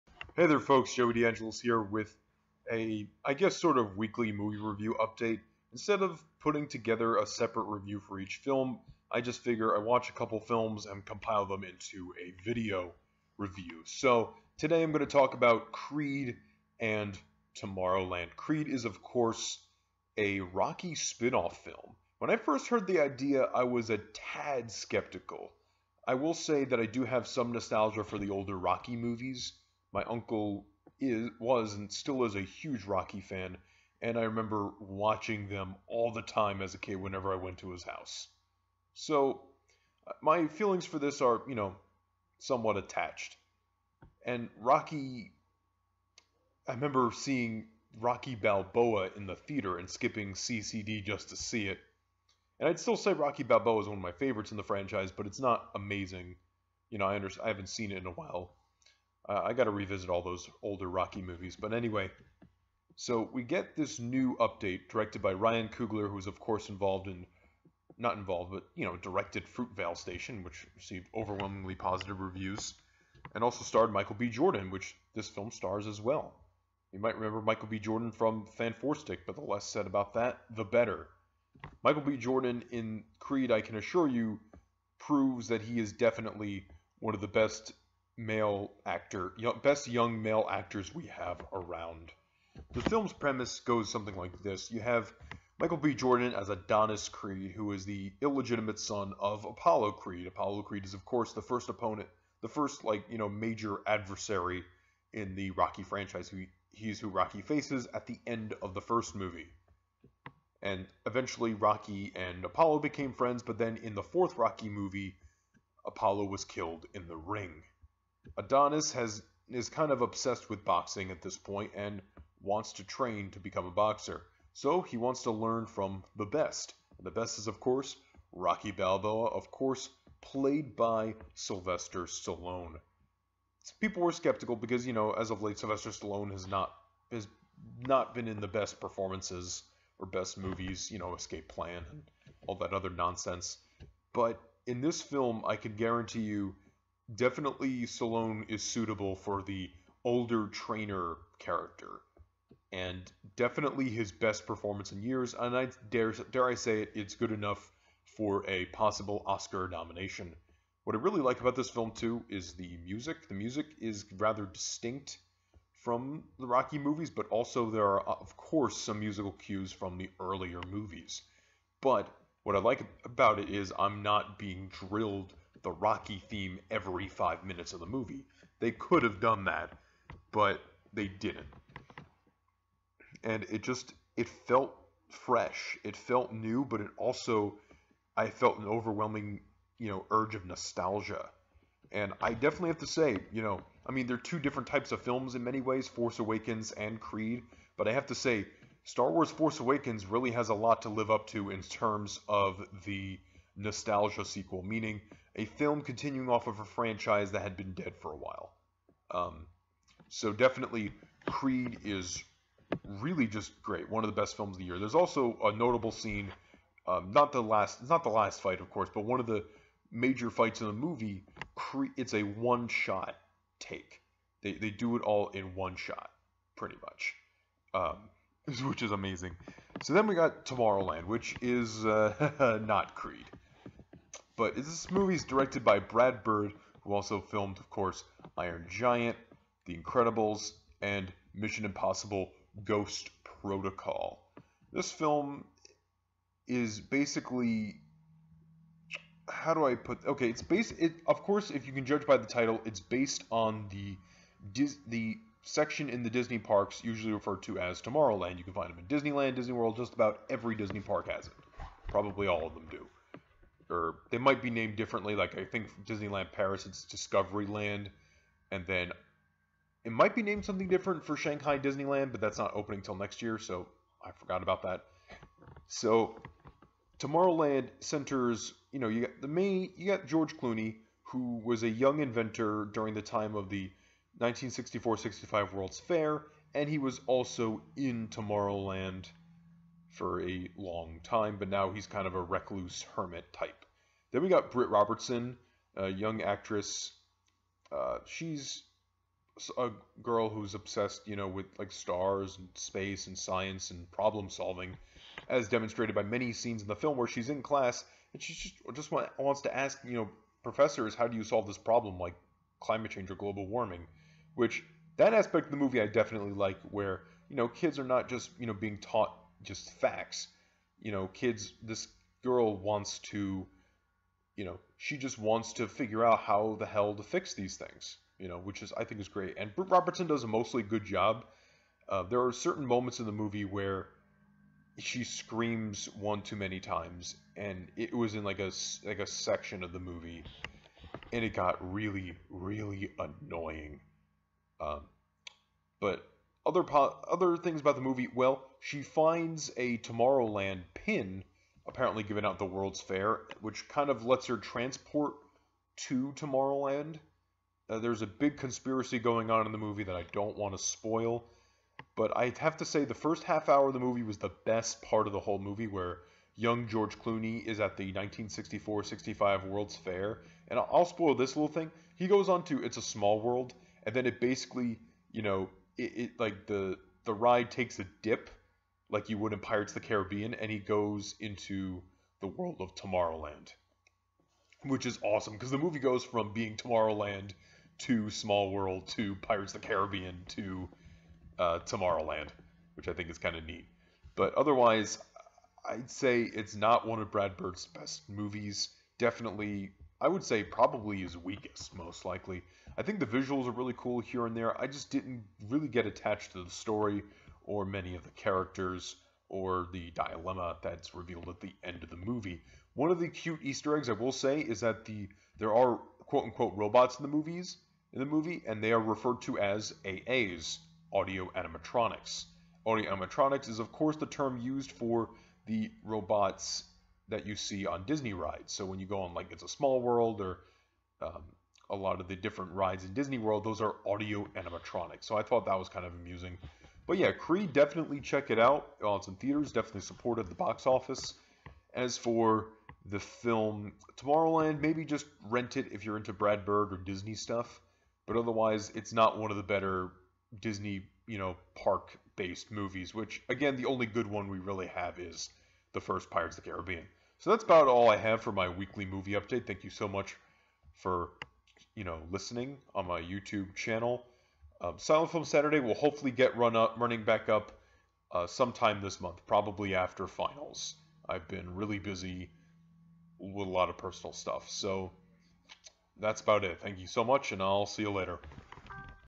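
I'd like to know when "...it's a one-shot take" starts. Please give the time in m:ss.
3:41.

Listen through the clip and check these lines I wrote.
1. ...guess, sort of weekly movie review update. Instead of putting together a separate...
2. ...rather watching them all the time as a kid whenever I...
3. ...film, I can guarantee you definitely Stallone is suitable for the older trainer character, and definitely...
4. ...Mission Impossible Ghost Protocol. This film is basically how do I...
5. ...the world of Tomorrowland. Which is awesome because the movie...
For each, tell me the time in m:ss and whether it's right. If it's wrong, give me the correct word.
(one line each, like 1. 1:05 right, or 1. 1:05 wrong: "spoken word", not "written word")
1. 0:03 right
2. 0:34 wrong: "remember", not "rather"
3. 2:25 right
4. 4:01 right
5. 6:22 right.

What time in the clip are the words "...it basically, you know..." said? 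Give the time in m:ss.
6:14.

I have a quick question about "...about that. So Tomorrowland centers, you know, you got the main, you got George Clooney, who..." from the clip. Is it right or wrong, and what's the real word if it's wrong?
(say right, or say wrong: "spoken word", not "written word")
right.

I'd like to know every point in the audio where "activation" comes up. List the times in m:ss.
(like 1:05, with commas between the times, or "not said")
not said.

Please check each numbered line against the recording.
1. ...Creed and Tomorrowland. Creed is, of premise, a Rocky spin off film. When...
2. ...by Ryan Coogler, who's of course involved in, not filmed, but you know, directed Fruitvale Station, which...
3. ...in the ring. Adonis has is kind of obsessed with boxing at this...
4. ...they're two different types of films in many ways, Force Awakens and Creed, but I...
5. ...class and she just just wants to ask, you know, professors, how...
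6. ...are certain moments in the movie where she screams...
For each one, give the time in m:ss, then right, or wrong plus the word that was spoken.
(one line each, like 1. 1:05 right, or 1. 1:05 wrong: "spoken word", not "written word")
1. 0:15 wrong: "course", not "premise"
2. 1:05 wrong: "involved", not "filmed"
3. 1:56 right
4. 3:14 right
5. 5:07 right
6. 5:32 right.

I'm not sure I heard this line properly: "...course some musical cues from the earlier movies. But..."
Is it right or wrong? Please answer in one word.
right.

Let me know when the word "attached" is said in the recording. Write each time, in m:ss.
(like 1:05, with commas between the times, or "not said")
0:42, 6:45.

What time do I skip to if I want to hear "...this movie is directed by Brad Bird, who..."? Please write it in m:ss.
3:54.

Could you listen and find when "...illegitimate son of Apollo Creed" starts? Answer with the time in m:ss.
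1:38.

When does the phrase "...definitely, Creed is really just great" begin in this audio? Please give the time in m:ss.
3:30.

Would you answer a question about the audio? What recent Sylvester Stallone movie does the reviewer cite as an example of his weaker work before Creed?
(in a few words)
Escape Plan.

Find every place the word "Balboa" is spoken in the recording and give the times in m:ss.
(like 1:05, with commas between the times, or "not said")
0:48, 0:53, 2:08.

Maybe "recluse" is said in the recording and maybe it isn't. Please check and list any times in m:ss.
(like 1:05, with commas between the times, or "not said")
4:52.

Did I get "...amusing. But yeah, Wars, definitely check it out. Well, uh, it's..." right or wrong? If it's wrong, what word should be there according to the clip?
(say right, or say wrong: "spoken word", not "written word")
wrong: "Creed", not "Wars".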